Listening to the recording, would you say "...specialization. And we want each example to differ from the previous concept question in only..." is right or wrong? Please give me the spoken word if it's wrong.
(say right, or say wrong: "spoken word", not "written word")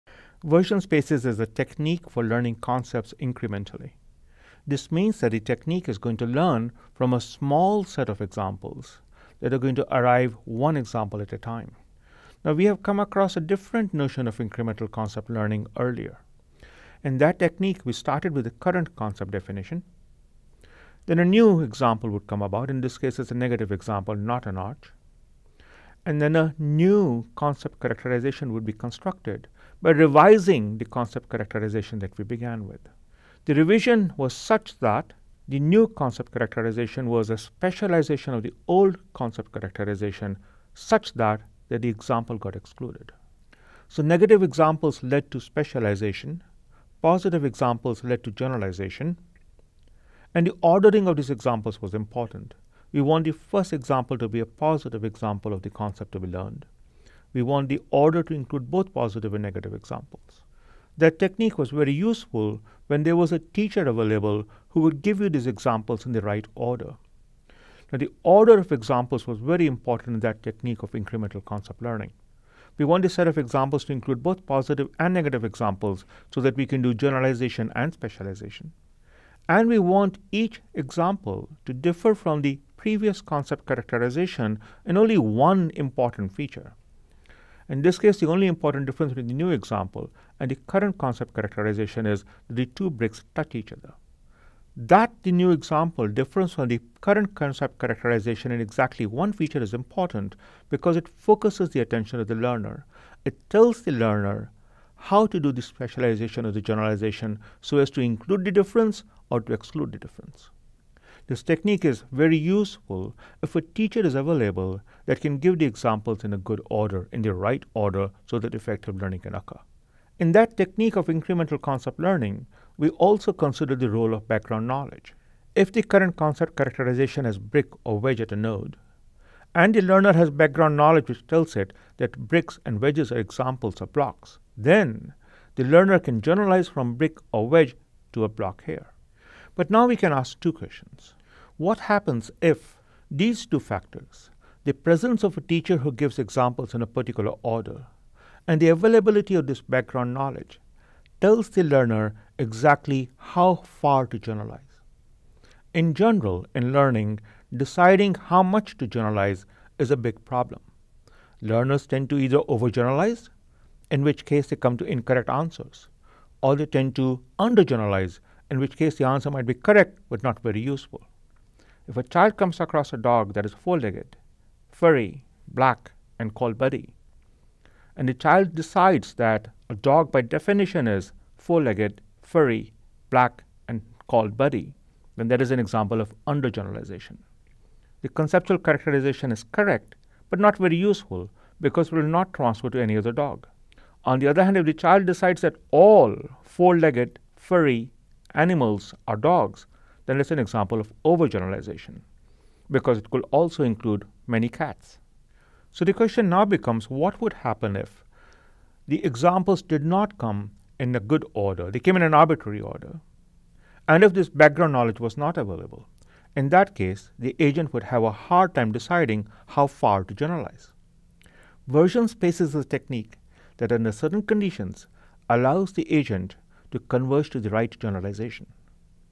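wrong: "characterization", not "question".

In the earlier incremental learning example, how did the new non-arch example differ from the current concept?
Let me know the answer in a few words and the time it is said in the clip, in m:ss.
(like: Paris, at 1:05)
The two bricks touch each other, at 1:32.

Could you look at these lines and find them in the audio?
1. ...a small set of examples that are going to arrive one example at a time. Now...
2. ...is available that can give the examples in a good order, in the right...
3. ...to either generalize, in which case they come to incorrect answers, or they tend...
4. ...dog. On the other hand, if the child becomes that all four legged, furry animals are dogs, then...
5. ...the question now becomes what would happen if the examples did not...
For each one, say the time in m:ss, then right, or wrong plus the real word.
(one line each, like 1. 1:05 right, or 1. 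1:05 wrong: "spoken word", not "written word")
1. 0:07 right
2. 1:54 right
3. 2:42 wrong: "overgeneralize", not "generalize"
4. 3:13 wrong: "decides", not "becomes"
5. 3:25 right.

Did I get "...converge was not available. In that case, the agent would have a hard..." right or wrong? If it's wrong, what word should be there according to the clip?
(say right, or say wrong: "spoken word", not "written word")
wrong: "knowledge", not "converge".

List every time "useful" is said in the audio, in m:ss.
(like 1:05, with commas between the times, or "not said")
1:01, 1:52, 2:50, 3:10.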